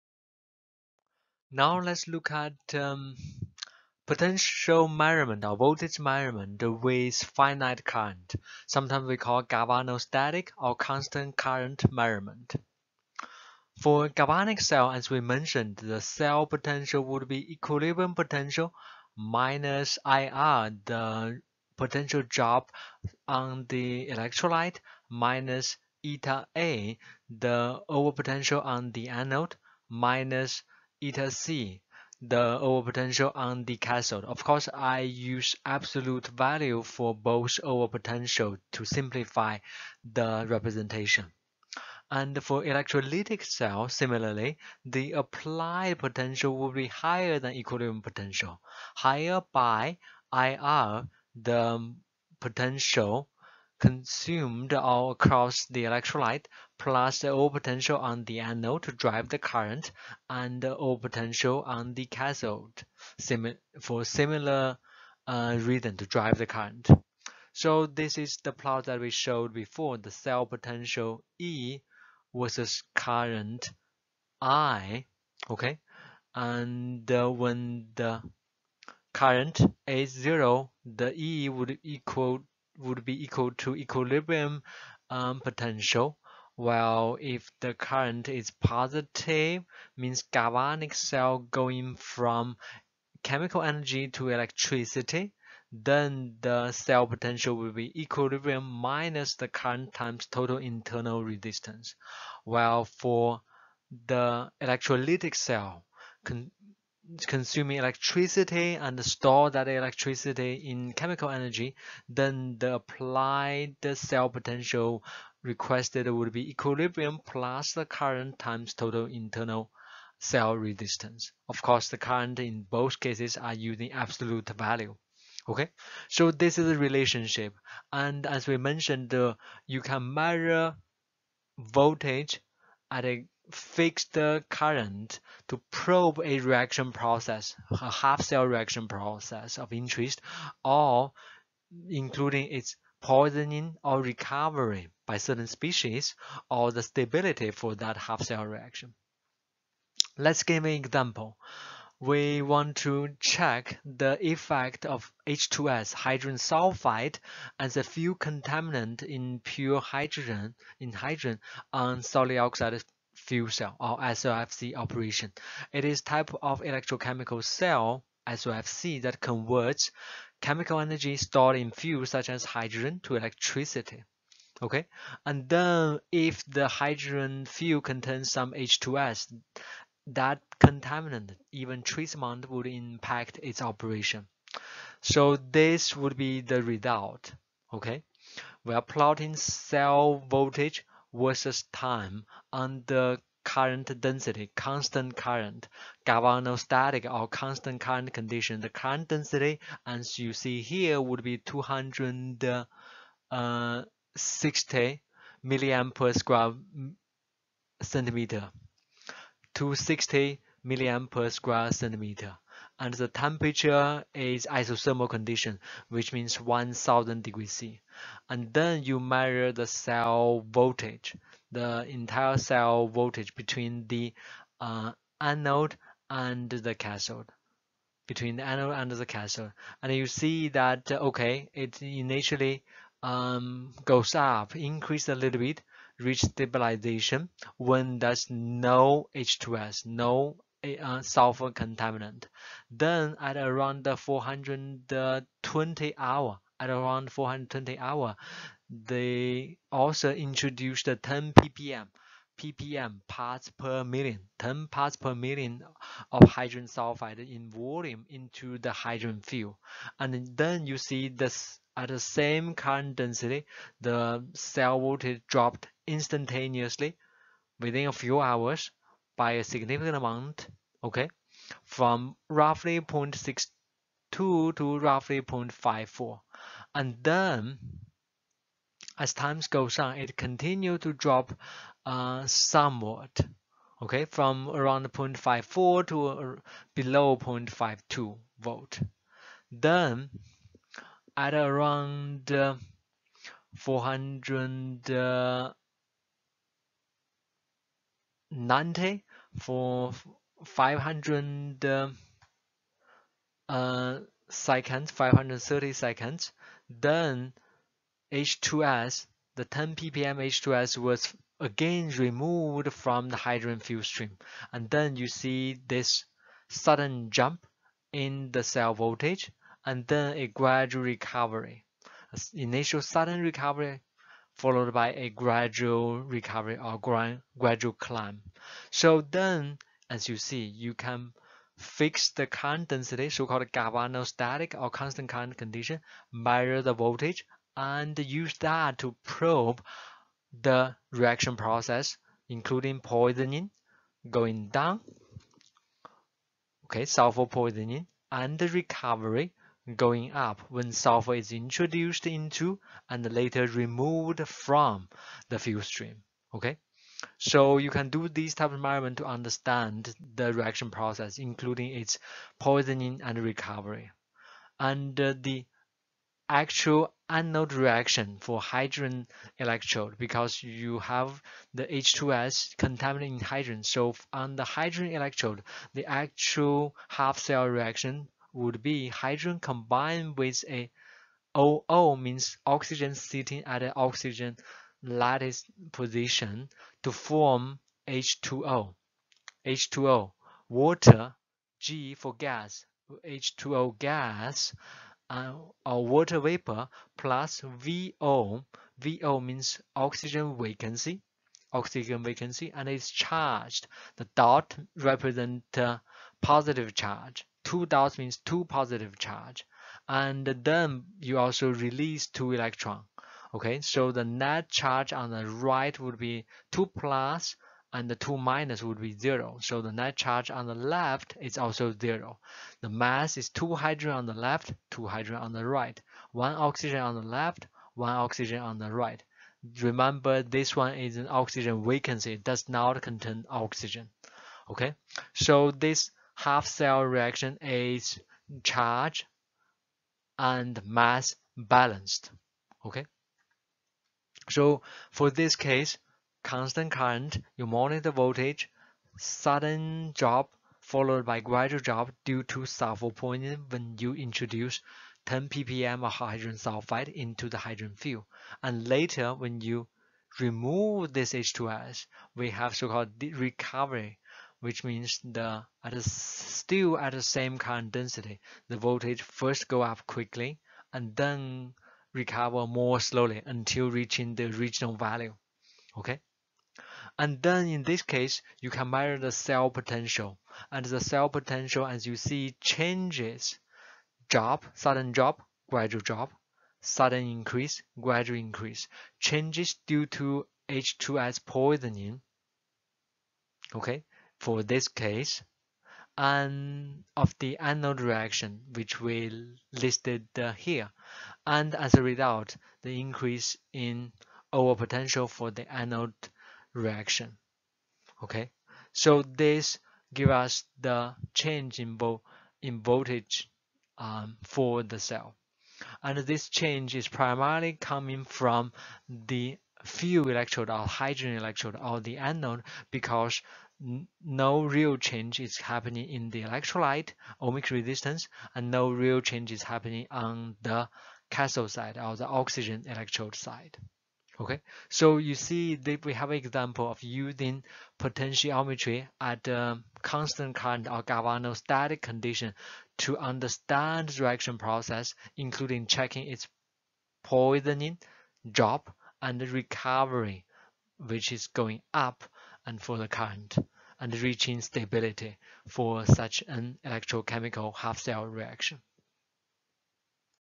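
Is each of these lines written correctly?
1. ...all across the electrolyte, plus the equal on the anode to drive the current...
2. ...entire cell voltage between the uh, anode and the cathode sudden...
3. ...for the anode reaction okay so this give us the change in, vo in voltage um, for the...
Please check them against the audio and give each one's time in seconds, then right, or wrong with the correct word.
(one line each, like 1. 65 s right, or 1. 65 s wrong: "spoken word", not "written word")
1. 54 s wrong: "overpotential", not "equal"
2. 221 s wrong: "between", not "sudden"
3. 505 s right.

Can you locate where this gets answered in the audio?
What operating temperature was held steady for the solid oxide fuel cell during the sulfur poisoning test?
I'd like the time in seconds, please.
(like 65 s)
216 s.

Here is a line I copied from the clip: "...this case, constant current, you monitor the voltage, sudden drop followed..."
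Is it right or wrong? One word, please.
right.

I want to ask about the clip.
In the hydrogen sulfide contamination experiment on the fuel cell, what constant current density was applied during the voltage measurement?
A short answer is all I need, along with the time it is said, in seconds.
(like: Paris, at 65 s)
260 mA/cm², at 201 s.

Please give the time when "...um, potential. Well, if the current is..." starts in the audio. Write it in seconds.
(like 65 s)
85 s.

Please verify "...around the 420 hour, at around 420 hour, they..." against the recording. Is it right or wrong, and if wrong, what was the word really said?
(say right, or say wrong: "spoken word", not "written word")
right.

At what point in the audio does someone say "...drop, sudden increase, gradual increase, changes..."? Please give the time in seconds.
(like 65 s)
485 s.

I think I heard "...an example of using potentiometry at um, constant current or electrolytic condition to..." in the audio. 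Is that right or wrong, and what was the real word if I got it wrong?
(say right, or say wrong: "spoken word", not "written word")
wrong: "galvanostatic", not "electrolytic".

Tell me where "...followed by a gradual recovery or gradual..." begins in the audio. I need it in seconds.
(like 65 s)
324 s.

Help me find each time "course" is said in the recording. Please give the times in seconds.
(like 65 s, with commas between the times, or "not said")
34 s, 121 s.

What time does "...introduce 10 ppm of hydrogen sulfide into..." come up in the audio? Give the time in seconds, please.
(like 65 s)
453 s.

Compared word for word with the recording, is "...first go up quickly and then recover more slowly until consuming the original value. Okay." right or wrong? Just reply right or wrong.
wrong.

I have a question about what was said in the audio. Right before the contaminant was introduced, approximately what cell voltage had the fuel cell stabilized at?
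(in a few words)
0.62.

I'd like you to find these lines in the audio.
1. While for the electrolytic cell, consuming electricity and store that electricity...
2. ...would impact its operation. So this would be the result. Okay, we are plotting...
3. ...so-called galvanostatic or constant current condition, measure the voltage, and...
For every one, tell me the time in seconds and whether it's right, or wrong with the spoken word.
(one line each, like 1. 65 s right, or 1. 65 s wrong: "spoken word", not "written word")
1. 102 s right
2. 182 s right
3. 333 s right.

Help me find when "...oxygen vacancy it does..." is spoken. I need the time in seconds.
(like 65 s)
431 s.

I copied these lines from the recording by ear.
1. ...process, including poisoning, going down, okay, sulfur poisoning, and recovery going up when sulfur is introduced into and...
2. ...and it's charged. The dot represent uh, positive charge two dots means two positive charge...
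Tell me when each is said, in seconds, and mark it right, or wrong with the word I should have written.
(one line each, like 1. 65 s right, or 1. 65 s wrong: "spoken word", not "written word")
1. 341 s right
2. 402 s right.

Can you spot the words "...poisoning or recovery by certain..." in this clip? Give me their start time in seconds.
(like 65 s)
143 s.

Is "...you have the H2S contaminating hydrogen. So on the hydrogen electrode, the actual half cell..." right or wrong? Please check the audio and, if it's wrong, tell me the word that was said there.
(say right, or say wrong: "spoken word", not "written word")
right.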